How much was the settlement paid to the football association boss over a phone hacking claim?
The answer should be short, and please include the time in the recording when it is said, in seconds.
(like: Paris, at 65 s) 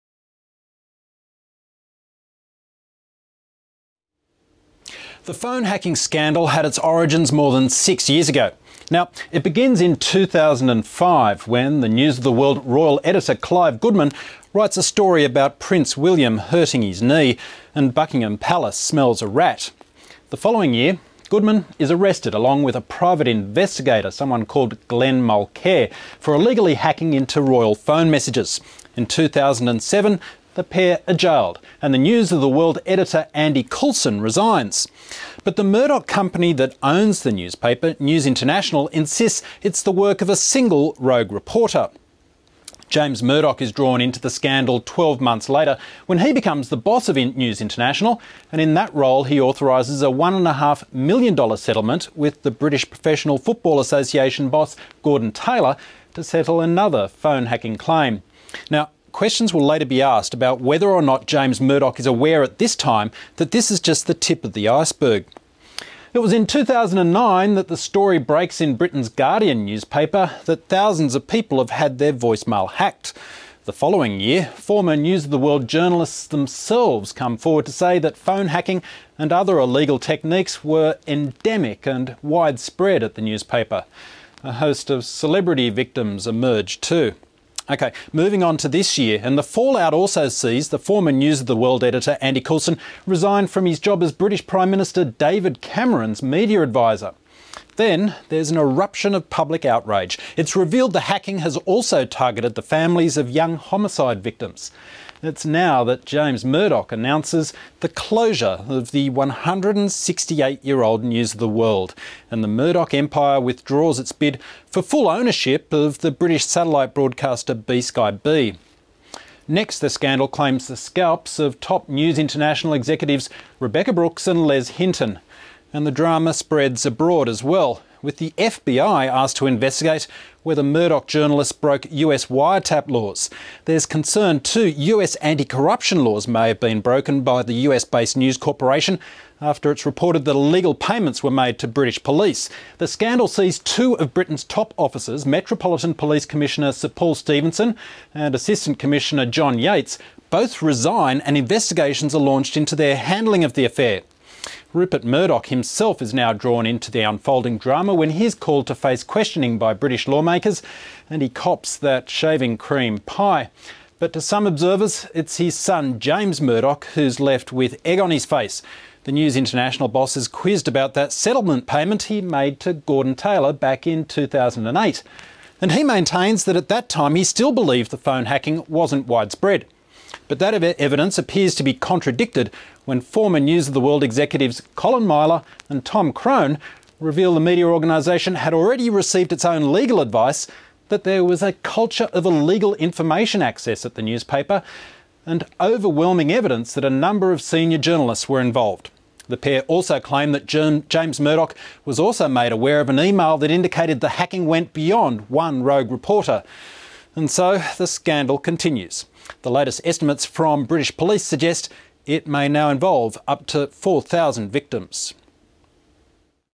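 $1.5 million, at 50 s.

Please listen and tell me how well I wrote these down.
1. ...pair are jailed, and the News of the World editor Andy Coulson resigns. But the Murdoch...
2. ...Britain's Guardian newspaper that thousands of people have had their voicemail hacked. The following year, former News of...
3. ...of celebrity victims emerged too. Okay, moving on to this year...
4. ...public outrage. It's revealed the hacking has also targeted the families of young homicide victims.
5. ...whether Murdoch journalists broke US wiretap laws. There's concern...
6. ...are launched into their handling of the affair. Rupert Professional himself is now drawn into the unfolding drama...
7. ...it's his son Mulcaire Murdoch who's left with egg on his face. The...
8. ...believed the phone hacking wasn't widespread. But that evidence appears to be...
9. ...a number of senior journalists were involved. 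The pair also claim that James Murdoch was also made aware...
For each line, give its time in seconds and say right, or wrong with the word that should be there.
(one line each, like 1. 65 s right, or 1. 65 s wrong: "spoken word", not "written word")
1. 30 s right
2. 68 s right
3. 84 s right
4. 99 s right
5. 130 s right
6. 152 s wrong: "Murdoch", not "Professional"
7. 165 s wrong: "James", not "Mulcaire"
8. 177 s right
9. 196 s right.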